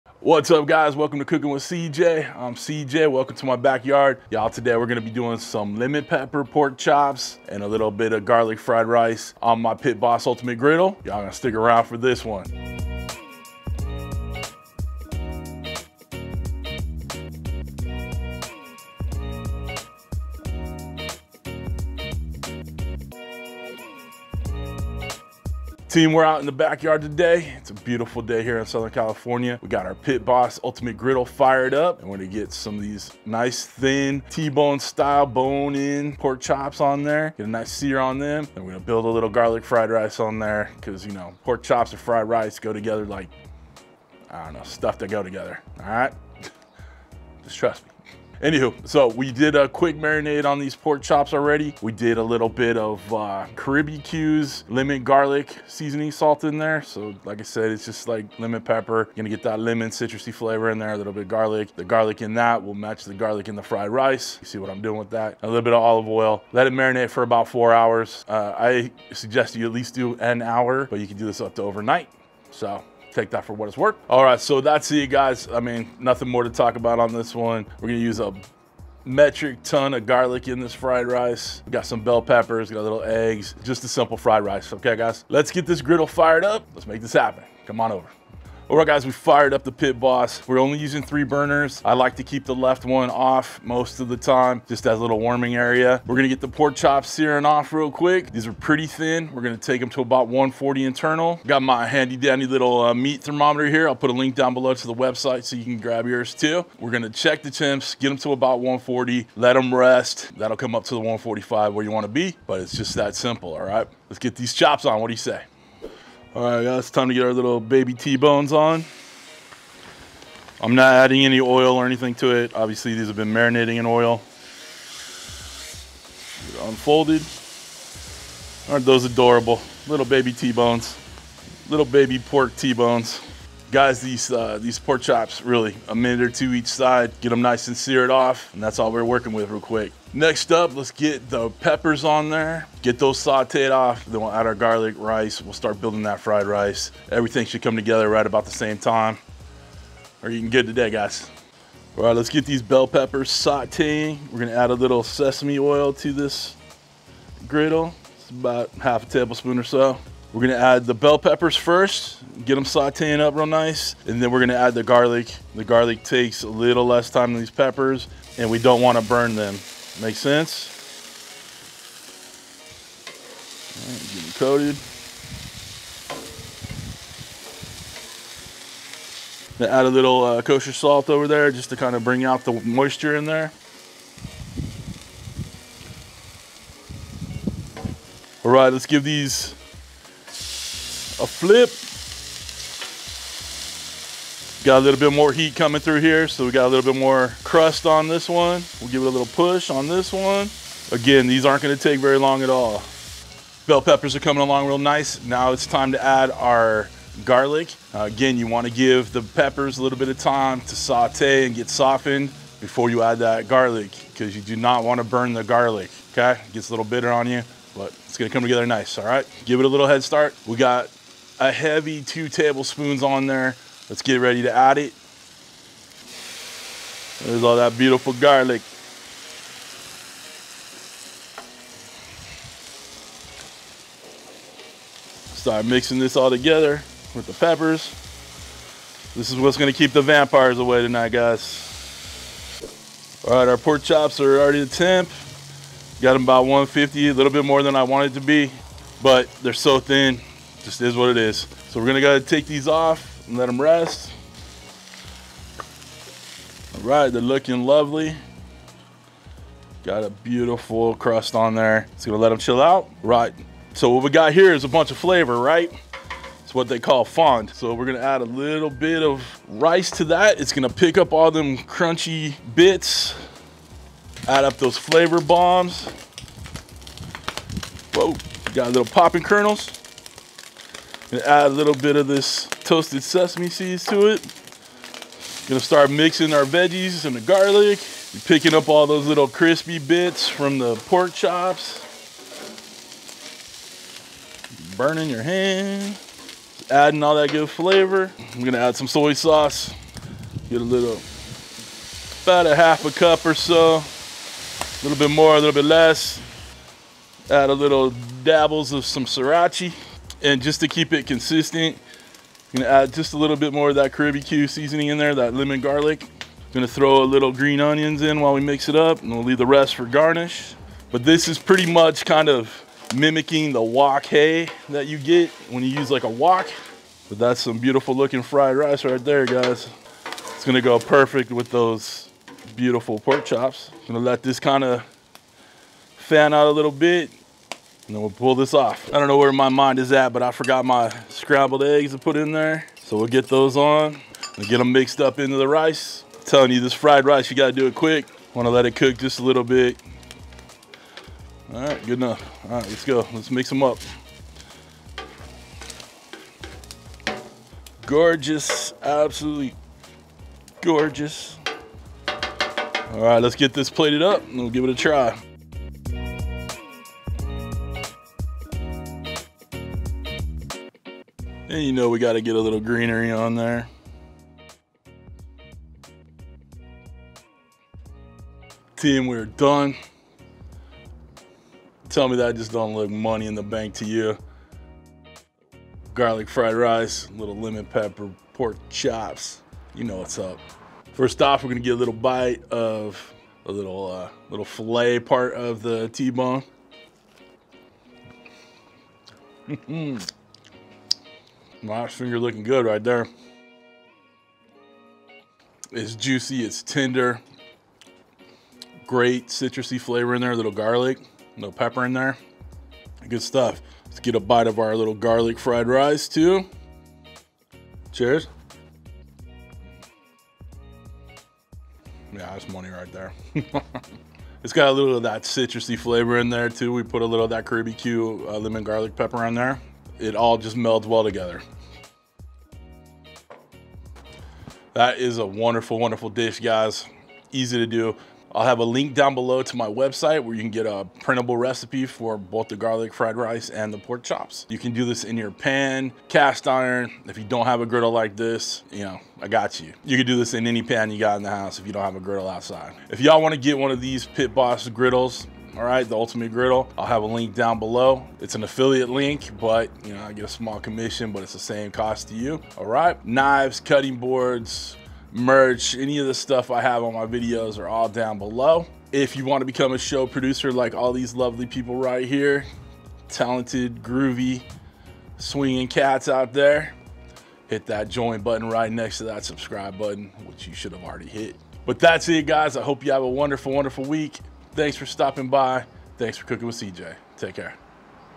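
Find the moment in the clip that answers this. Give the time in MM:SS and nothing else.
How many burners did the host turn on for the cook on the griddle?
01:31.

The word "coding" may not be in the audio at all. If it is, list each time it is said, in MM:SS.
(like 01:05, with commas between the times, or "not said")
not said.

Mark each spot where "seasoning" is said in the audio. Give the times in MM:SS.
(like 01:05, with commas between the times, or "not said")
00:55, 05:14.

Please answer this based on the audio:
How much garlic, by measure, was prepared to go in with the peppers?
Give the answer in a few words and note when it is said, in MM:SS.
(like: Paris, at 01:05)
2 tablespoons, at 03:42.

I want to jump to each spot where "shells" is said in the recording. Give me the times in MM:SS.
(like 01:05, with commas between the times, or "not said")
not said.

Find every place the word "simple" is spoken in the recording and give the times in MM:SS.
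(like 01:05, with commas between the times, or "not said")
01:23, 01:53.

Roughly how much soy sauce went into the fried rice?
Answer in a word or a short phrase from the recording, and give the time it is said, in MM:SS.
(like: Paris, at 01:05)
half a cup, at 05:02.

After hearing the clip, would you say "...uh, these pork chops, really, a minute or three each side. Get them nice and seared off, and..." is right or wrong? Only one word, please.
wrong.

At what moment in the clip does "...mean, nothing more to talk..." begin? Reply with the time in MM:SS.
01:15.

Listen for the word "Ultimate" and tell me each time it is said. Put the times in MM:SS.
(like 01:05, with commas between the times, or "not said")
00:10, 00:30, 07:35.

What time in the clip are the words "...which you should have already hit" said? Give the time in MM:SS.
08:00.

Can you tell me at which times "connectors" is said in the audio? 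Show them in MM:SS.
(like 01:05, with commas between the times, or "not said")
not said.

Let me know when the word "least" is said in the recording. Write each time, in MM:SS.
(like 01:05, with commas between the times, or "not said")
01:09.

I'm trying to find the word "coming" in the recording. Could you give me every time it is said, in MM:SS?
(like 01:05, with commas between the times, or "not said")
03:15, 03:24.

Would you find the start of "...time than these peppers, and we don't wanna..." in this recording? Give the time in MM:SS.
02:47.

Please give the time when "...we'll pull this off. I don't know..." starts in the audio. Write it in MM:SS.
05:38.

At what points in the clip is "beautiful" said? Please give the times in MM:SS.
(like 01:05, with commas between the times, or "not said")
00:27, 03:47, 04:20, 05:27, 05:32.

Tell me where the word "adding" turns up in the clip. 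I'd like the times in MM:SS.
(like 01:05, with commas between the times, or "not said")
02:00, 04:56.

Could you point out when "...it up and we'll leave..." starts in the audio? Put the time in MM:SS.
05:18.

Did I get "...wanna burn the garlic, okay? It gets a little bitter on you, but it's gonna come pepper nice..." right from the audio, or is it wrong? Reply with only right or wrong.
wrong.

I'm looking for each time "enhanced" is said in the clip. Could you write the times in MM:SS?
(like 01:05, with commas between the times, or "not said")
not said.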